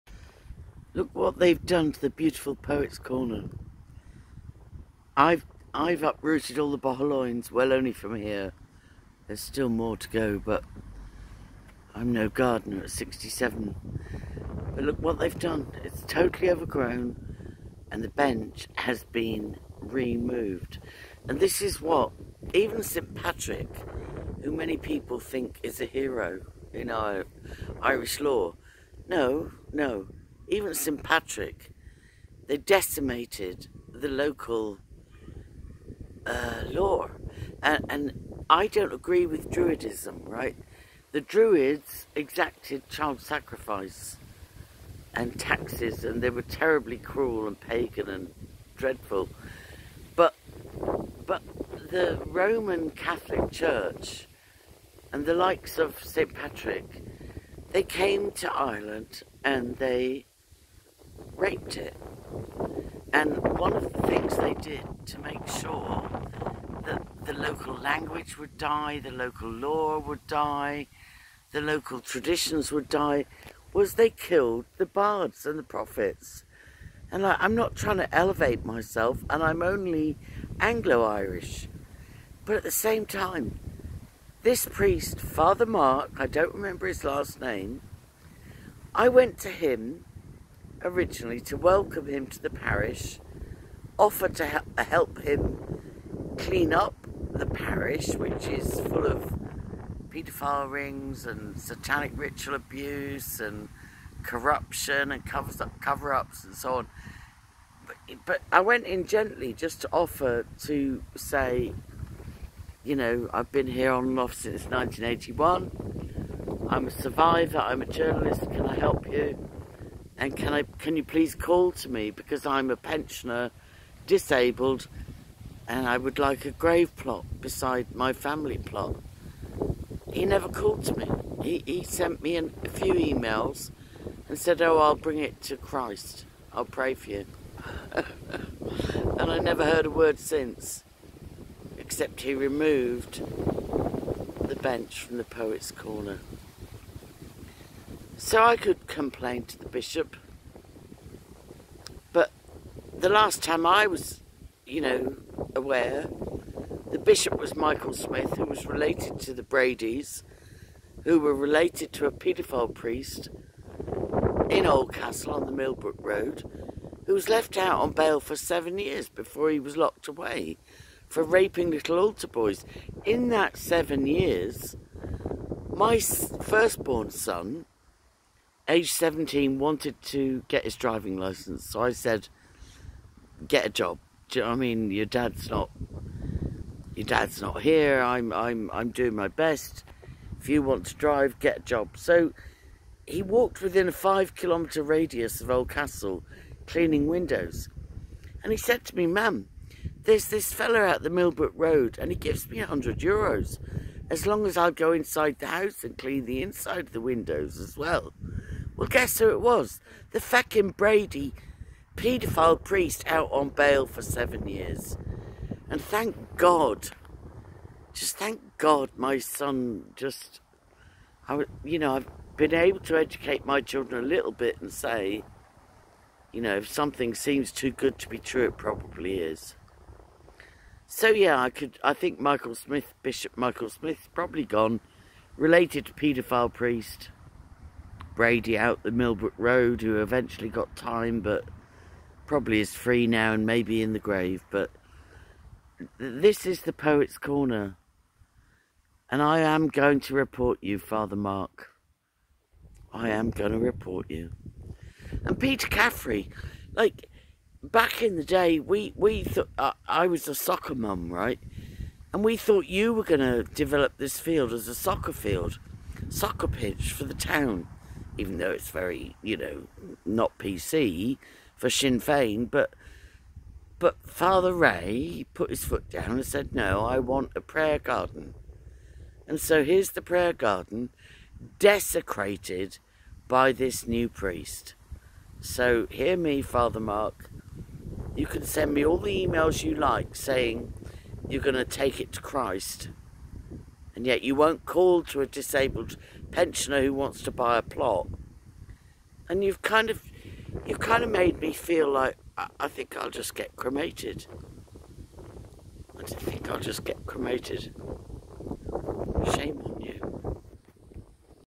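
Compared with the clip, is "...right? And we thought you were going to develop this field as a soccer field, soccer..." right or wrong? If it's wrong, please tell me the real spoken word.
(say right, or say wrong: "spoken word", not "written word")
right.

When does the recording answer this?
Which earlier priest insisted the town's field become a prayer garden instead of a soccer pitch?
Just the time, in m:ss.
4:34.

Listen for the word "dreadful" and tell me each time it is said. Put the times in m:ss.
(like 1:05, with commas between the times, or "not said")
0:48.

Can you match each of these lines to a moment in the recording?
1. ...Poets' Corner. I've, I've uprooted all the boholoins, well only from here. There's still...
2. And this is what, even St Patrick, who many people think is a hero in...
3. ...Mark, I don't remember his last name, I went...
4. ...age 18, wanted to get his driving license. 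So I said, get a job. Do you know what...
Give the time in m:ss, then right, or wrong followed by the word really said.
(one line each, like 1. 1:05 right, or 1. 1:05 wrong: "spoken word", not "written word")
1. 0:02 right
2. 0:21 right
3. 1:25 right
4. 2:58 wrong: "17", not "18".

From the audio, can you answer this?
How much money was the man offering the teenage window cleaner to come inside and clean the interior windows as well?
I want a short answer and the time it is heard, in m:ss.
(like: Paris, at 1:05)
100 euros, at 3:22.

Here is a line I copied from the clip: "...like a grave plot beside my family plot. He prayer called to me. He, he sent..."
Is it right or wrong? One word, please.
wrong.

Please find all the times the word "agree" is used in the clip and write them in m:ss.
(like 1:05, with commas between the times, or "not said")
0:38.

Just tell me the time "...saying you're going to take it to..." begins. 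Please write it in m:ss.
4:50.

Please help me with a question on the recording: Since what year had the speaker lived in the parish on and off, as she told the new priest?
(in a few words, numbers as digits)
1981.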